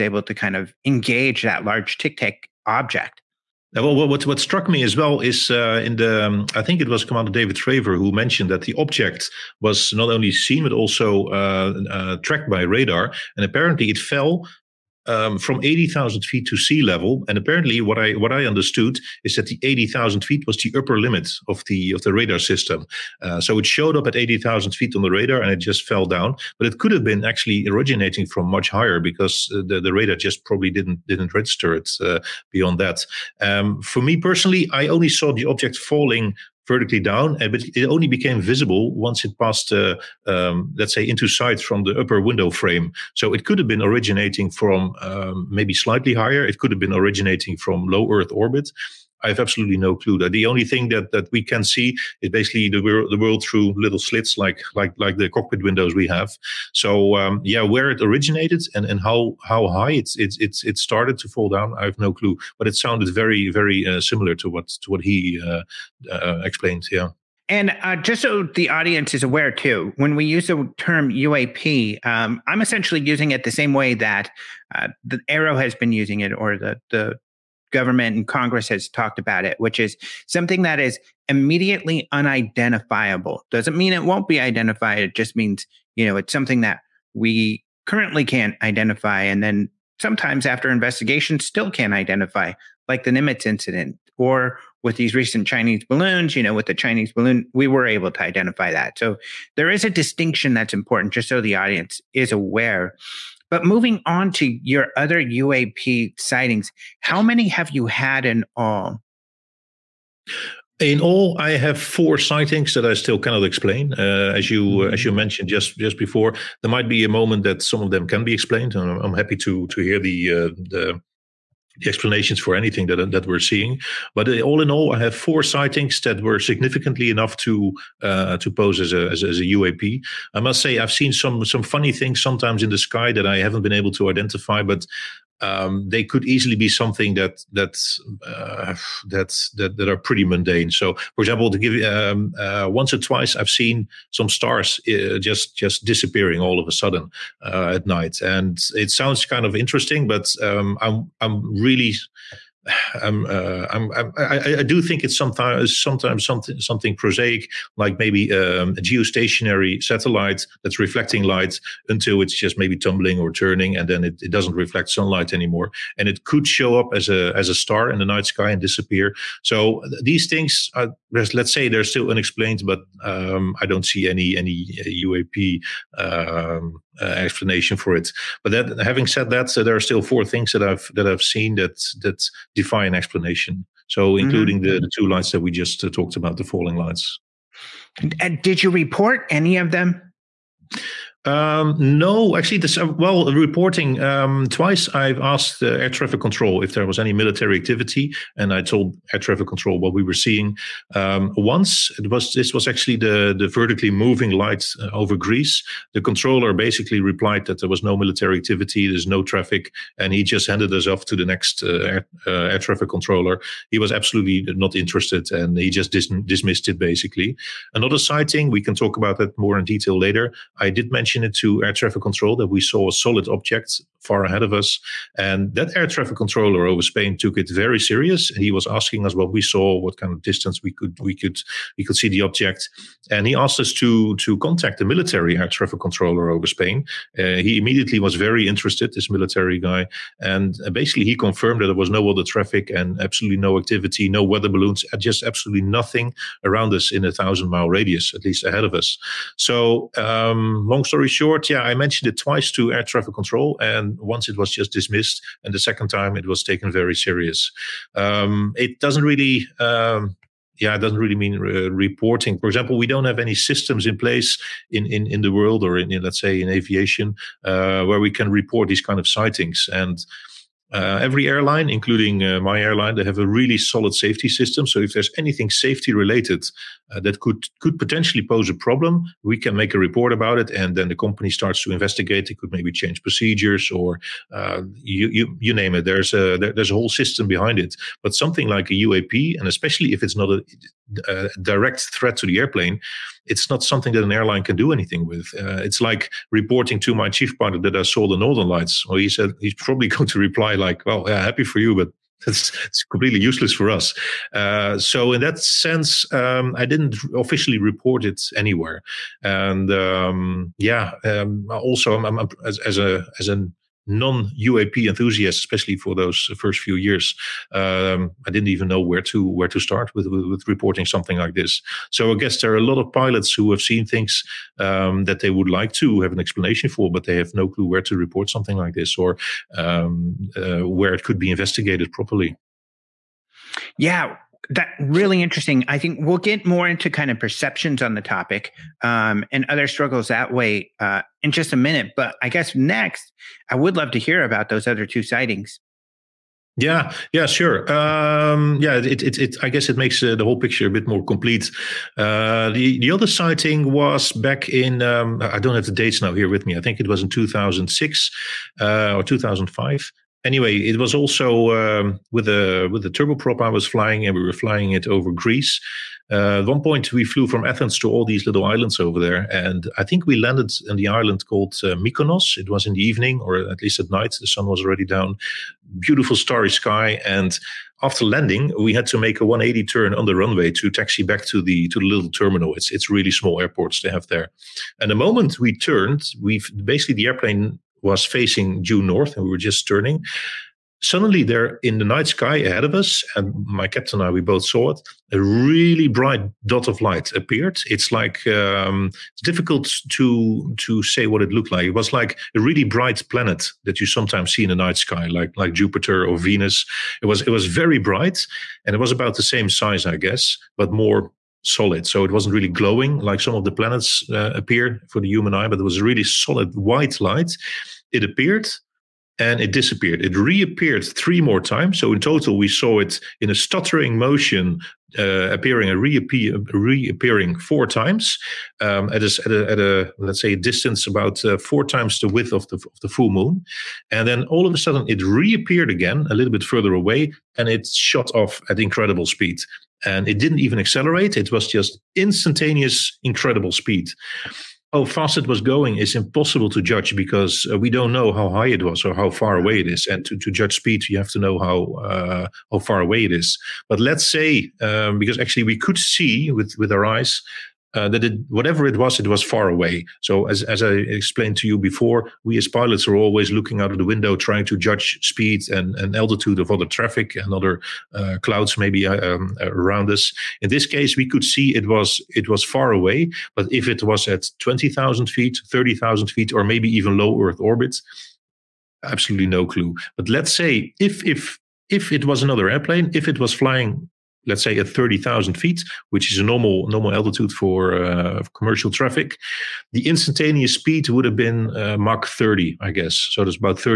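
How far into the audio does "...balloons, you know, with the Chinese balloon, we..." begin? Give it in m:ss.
1:35.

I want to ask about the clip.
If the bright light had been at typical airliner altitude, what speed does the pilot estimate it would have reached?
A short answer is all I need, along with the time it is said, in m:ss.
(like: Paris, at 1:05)
Mach 30, at 8:11.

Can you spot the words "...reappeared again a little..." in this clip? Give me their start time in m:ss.
7:15.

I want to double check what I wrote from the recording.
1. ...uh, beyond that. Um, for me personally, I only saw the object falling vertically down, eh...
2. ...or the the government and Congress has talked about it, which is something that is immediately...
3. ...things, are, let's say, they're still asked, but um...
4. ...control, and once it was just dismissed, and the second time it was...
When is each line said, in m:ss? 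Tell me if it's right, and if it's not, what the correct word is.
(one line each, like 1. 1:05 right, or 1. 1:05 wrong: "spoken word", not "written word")
1. 0:32 right
2. 1:16 right
3. 2:50 wrong: "unexplained", not "asked"
4. 4:13 right.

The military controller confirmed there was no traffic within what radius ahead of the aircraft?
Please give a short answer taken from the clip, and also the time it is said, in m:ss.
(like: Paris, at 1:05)
1,000 miles, at 4:07.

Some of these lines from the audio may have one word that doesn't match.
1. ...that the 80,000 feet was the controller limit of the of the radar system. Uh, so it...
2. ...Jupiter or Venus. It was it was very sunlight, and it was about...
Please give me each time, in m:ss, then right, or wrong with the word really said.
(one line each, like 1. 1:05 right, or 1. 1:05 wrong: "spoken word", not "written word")
1. 0:19 wrong: "upper", not "controller"
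2. 6:45 wrong: "bright", not "sunlight".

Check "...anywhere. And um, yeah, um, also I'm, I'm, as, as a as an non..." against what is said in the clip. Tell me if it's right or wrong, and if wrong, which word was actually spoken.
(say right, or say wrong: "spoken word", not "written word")
right.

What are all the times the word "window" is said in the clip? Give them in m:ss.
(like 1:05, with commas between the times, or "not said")
0:42, 0:55, 7:43.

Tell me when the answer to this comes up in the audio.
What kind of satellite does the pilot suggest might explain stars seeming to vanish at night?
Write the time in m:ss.
2:38.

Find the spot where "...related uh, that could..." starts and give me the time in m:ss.
4:35.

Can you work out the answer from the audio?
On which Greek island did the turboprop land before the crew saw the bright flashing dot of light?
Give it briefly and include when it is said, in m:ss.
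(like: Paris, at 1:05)
Mykonos, at 6:11.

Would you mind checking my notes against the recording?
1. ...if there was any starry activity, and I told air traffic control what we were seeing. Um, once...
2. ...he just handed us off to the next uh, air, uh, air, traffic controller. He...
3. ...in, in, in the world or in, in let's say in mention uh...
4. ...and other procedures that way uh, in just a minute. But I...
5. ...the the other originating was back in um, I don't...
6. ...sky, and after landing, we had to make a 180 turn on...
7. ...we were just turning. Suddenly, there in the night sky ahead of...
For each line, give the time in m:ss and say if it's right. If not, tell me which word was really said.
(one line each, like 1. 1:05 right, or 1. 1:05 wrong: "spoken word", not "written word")
1. 3:16 wrong: "military", not "starry"
2. 3:30 right
3. 4:24 wrong: "aviation", not "mention"
4. 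5:39 wrong: "struggles", not "procedures"
5. 5:52 wrong: "sighting", not "originating"
6. 6:16 right
7. 6:29 right.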